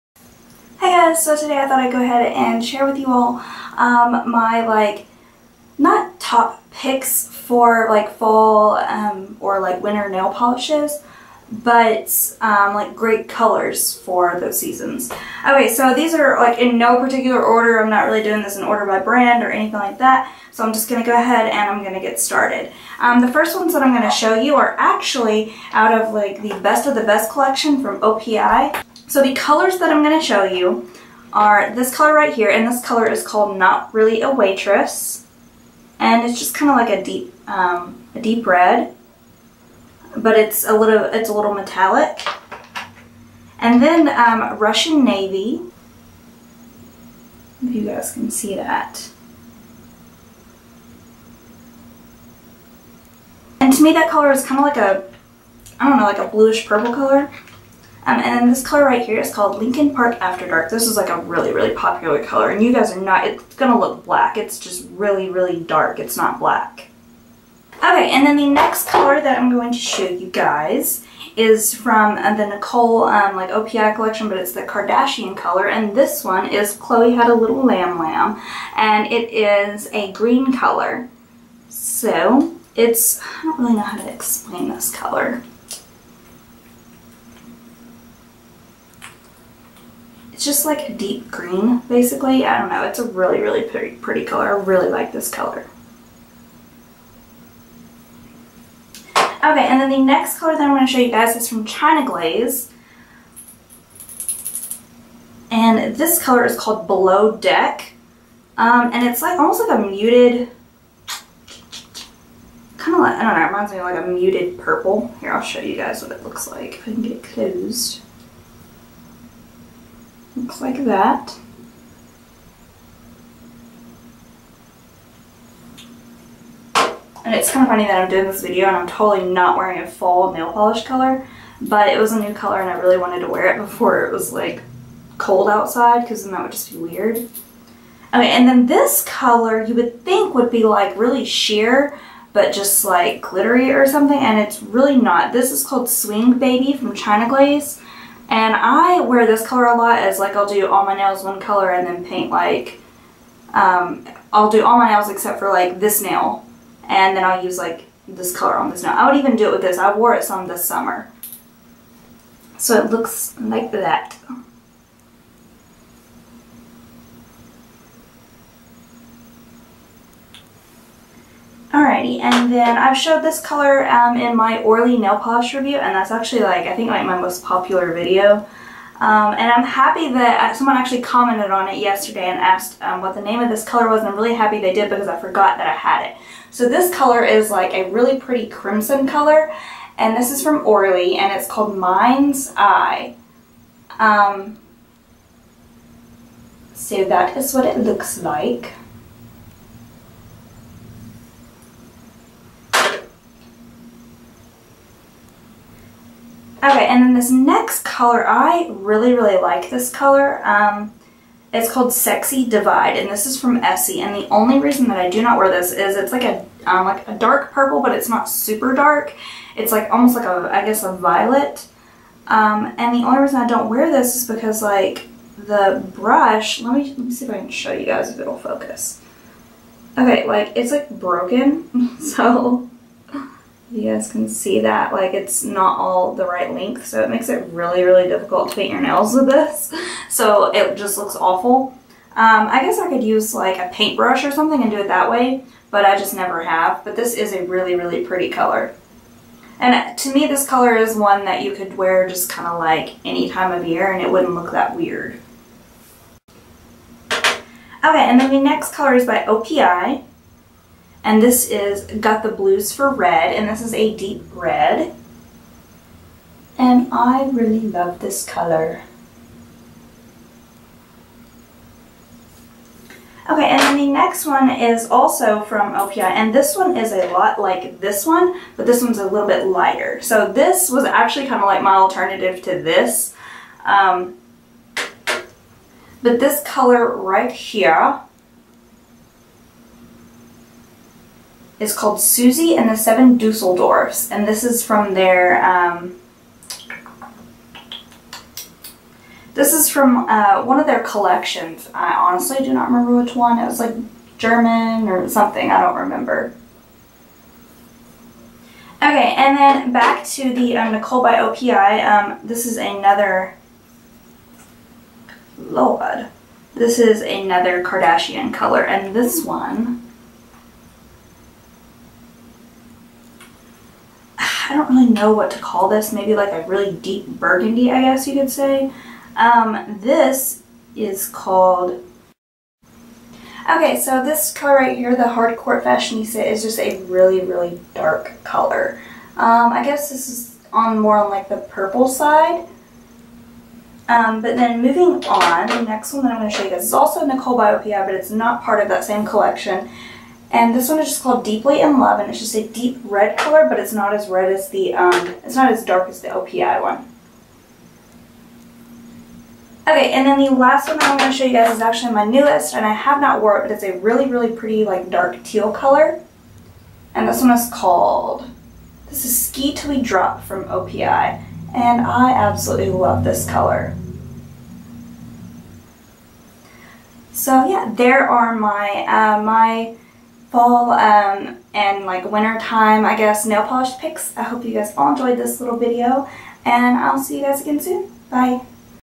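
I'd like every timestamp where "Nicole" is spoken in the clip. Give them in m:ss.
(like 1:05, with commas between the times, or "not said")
1:12, 5:10, 5:47.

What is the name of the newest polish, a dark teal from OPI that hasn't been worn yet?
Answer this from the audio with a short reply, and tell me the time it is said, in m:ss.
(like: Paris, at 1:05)
Ski Teal We Drop, at 6:09.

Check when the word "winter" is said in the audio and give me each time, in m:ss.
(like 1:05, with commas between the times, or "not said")
0:09, 6:22.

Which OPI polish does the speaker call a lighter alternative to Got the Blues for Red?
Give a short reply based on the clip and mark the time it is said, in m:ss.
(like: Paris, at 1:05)
Susie and the Seven Dusseldorfs, at 4:52.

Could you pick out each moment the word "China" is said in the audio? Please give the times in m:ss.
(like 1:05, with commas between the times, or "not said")
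1:41, 2:26.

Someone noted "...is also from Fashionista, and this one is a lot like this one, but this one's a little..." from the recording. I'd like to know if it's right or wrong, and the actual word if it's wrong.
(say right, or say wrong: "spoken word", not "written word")
wrong: "OPI", not "Fashionista".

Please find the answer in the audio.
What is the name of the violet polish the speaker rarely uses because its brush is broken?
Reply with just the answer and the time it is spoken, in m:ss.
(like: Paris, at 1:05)
Sexy Divide, at 3:31.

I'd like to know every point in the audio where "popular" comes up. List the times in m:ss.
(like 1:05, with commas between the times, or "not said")
1:01, 2:57.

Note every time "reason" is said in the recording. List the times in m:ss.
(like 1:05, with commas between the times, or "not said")
3:34, 3:43.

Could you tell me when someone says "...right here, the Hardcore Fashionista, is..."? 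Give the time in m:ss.
5:34.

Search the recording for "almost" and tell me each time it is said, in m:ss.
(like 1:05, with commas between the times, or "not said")
1:49, 3:39.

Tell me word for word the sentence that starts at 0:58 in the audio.
Um, and then this color right here is called Lincoln Park After Dark.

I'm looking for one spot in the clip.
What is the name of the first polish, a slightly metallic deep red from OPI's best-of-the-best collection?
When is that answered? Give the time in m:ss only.
0:33.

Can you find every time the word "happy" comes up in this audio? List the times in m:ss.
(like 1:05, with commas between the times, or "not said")
2:59, 3:04.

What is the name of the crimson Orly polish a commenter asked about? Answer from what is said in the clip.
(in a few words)
Mind's Eye.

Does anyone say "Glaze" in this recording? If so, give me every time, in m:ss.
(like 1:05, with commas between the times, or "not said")
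1:42, 2:27.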